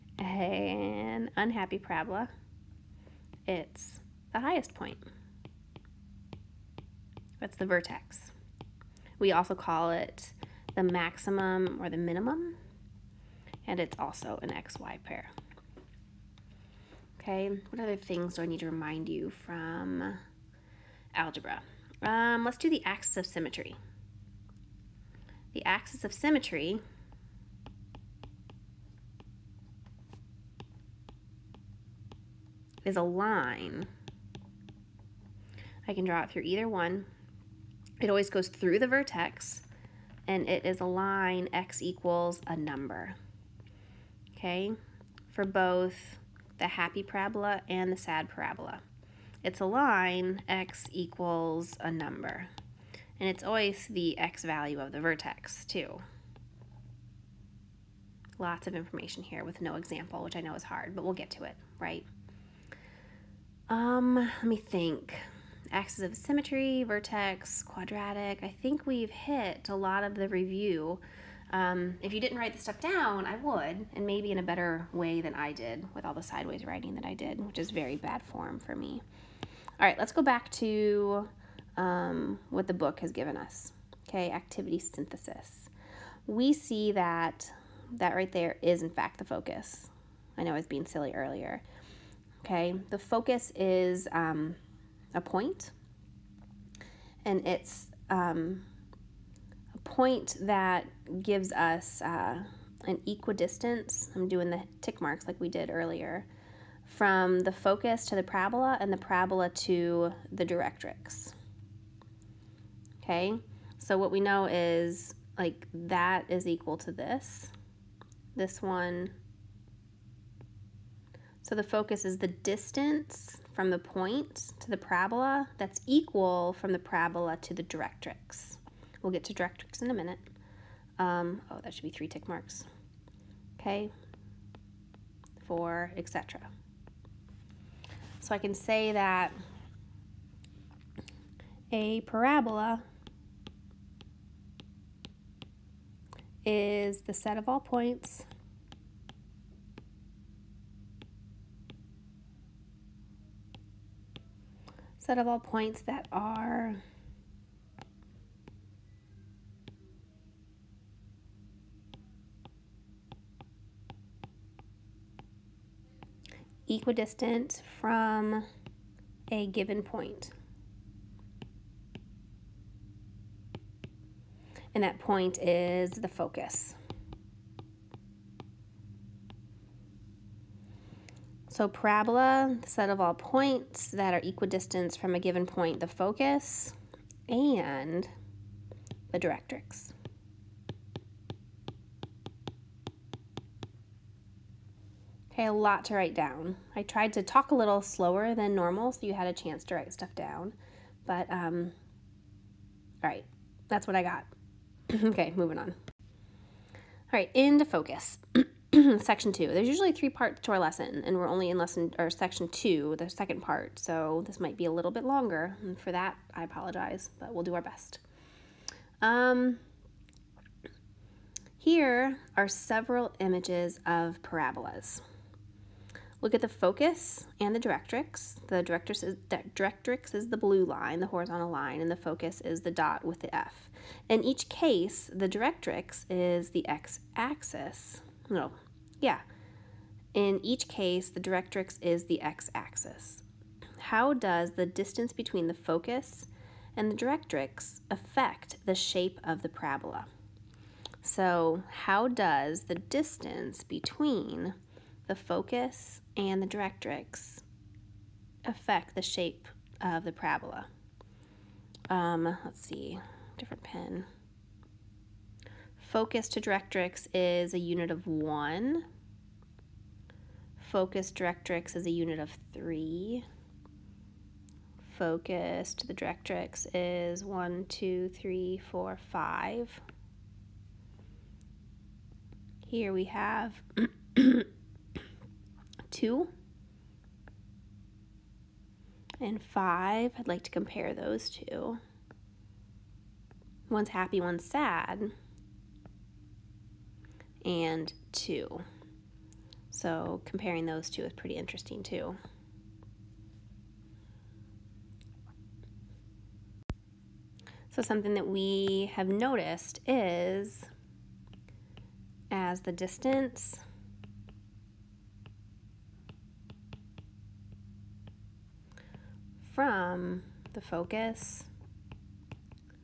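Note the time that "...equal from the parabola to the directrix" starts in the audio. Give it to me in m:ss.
2:05.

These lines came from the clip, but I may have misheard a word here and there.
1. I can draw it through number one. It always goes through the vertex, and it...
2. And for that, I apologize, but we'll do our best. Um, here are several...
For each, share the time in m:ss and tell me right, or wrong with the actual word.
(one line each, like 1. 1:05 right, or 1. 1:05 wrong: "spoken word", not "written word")
1. 0:35 wrong: "either", not "number"
2. 3:35 right.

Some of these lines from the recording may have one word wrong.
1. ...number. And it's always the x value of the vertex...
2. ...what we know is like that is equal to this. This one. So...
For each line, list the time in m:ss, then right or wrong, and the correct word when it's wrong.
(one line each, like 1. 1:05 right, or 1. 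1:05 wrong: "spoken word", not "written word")
1. 0:51 right
2. 1:53 right.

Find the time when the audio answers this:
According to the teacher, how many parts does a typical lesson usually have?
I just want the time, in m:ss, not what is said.
3:29.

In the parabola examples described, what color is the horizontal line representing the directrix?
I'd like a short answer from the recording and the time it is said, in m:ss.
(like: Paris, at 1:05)
blue, at 3:50.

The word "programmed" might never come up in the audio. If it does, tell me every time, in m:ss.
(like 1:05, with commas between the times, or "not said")
not said.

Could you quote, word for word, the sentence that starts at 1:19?
All right, let's go back to um, what the book has given us.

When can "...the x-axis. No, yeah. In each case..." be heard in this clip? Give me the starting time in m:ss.
3:56.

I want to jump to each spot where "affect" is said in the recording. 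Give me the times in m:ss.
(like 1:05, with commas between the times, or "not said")
4:07, 4:18.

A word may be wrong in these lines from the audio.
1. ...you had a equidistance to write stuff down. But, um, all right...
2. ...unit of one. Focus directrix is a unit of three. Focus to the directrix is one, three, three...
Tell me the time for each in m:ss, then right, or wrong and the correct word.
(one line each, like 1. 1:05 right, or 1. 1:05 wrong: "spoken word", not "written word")
1. 3:19 wrong: "chance", not "equidistance"
2. 4:27 wrong: "two", not "three".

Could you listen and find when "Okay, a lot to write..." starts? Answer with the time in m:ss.
3:15.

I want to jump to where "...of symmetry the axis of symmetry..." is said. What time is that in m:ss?
0:23.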